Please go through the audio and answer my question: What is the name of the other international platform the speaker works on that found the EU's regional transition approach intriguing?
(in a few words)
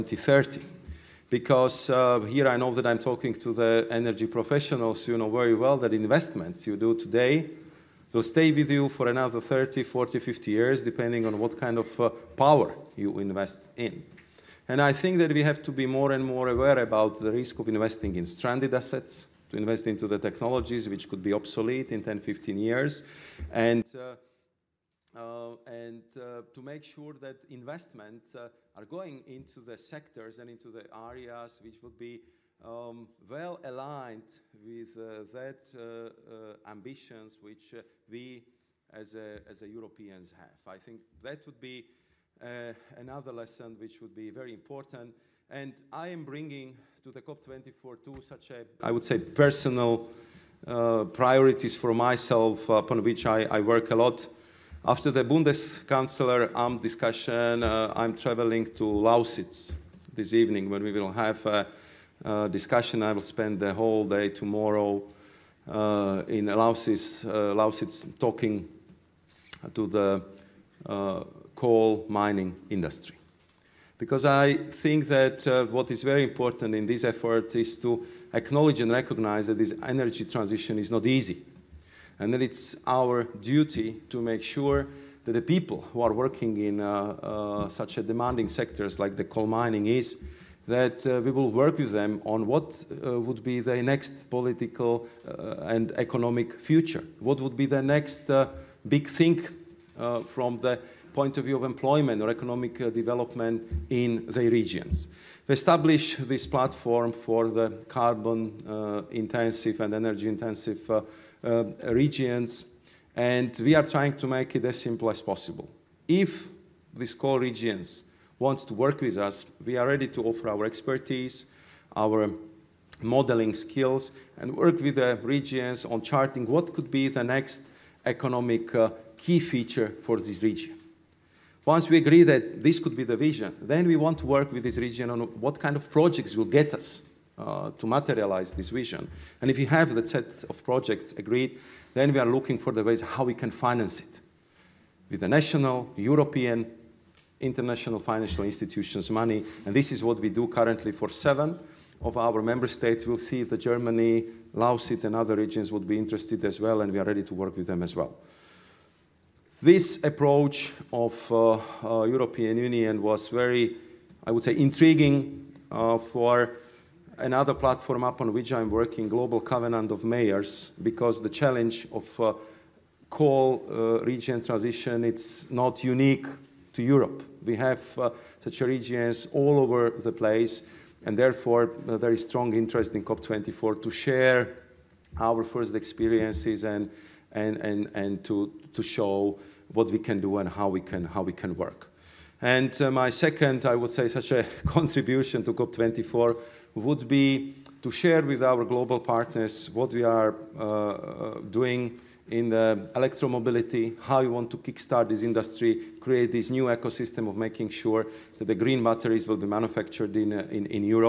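Global Covenant of Mayors.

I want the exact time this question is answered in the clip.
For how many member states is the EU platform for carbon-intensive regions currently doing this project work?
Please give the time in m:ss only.
2:31.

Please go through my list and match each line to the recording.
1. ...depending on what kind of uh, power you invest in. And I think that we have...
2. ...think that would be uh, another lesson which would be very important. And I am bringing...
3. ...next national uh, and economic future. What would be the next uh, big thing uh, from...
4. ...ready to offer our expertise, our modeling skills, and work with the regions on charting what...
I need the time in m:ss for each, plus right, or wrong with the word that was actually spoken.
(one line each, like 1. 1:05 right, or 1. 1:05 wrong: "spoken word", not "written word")
1. 0:10 right
2. 0:40 right
3. 1:33 wrong: "political", not "national"
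4. 1:59 right.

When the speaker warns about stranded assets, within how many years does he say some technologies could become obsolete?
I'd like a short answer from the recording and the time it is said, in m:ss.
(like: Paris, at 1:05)
10, 15 years, at 0:22.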